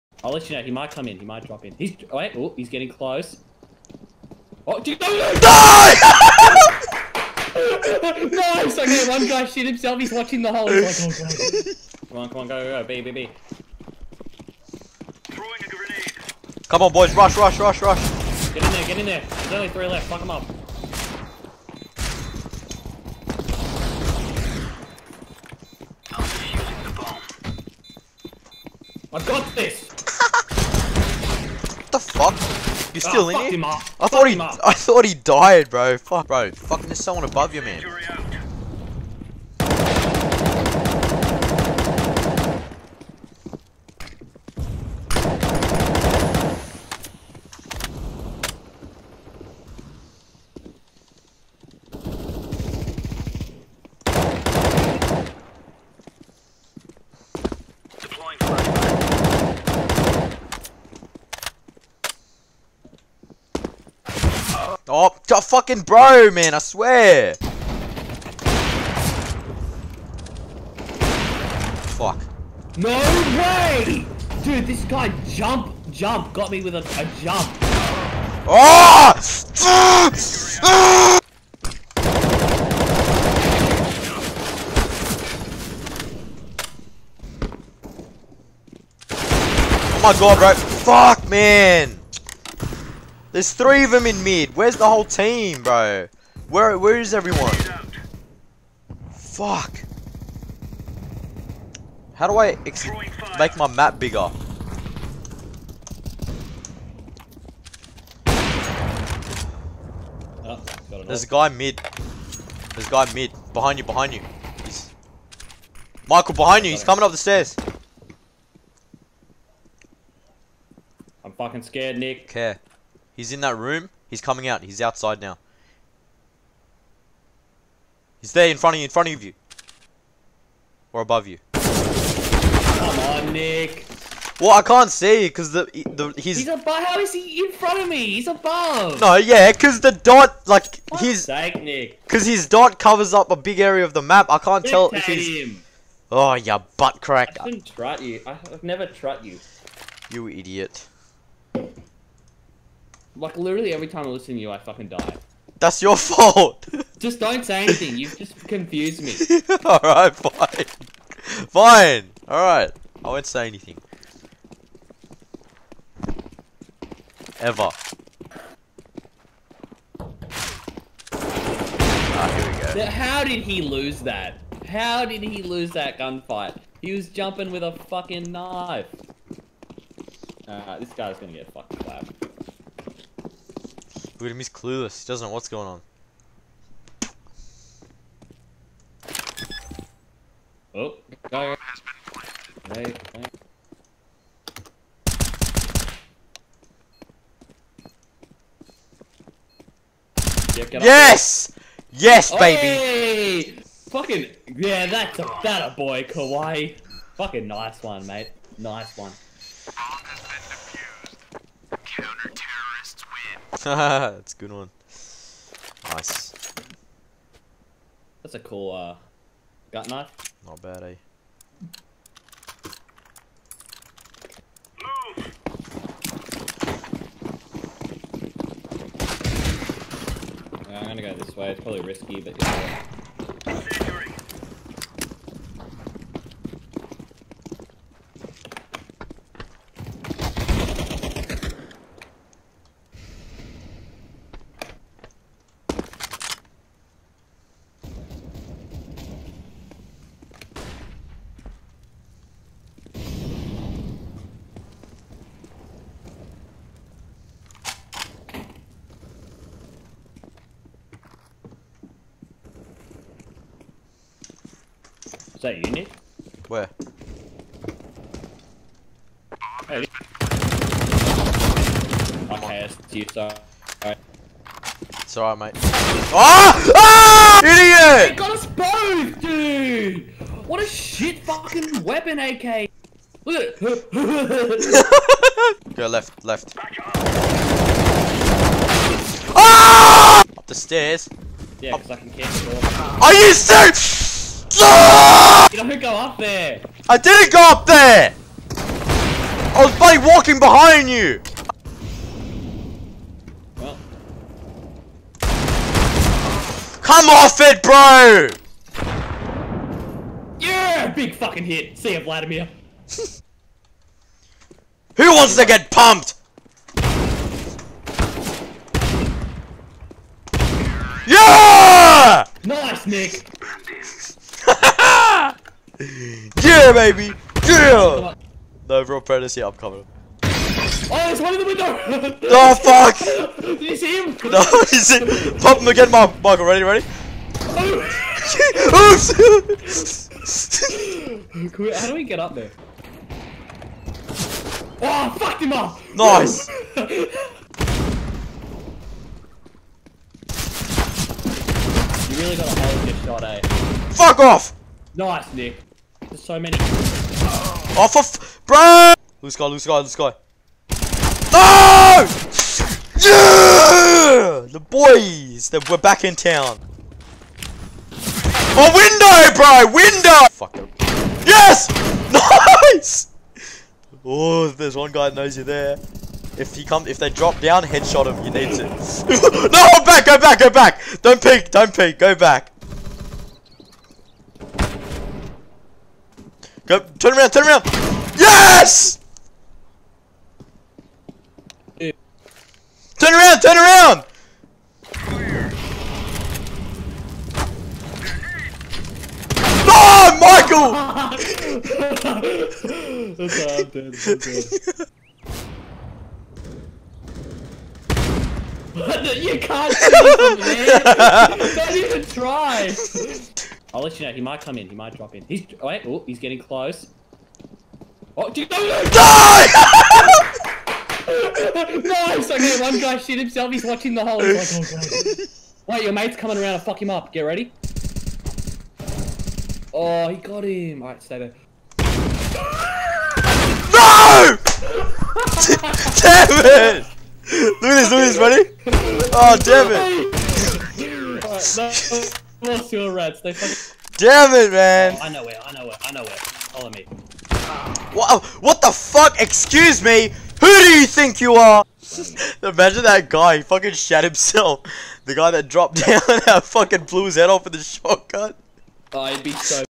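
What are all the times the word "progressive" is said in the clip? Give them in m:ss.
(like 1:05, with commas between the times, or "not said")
not said.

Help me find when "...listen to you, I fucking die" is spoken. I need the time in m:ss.
2:34.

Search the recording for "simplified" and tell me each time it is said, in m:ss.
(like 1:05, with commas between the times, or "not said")
not said.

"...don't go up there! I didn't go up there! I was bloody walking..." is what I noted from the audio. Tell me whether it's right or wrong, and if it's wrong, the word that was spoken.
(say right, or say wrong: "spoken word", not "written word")
right.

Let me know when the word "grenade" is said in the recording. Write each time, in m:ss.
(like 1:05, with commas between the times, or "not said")
0:15.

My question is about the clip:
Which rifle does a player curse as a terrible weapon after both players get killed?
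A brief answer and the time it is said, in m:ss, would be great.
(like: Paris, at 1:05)
AK, at 4:42.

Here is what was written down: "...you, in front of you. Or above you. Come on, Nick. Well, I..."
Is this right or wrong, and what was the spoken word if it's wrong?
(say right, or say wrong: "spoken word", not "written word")
right.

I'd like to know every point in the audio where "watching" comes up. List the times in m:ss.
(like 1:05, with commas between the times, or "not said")
0:10, 7:03.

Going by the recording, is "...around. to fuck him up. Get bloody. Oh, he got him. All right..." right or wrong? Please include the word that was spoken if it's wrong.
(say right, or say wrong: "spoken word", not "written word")
wrong: "ready", not "bloody".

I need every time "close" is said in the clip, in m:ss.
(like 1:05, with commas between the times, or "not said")
0:02, 6:56.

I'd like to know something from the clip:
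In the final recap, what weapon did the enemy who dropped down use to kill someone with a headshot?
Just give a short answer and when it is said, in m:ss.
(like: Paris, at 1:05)
Shotgun, at 7:37.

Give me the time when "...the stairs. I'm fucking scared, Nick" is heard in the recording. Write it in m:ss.
1:57.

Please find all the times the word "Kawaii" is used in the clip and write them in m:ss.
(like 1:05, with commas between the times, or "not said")
3:26.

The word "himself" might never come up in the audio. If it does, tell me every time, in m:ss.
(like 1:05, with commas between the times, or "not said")
0:09, 7:03, 7:34.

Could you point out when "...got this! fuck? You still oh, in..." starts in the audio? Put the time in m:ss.
0:29.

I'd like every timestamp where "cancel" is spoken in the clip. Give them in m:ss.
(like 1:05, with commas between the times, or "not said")
4:52.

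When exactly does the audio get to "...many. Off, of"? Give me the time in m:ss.
5:56.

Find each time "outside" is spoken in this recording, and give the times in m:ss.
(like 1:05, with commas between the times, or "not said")
2:04.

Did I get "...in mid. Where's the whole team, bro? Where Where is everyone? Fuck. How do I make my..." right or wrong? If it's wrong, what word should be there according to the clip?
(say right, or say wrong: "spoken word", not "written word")
right.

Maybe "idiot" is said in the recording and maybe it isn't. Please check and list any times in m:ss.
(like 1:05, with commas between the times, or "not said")
2:30, 4:37.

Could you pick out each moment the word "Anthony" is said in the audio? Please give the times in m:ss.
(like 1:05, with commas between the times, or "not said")
not said.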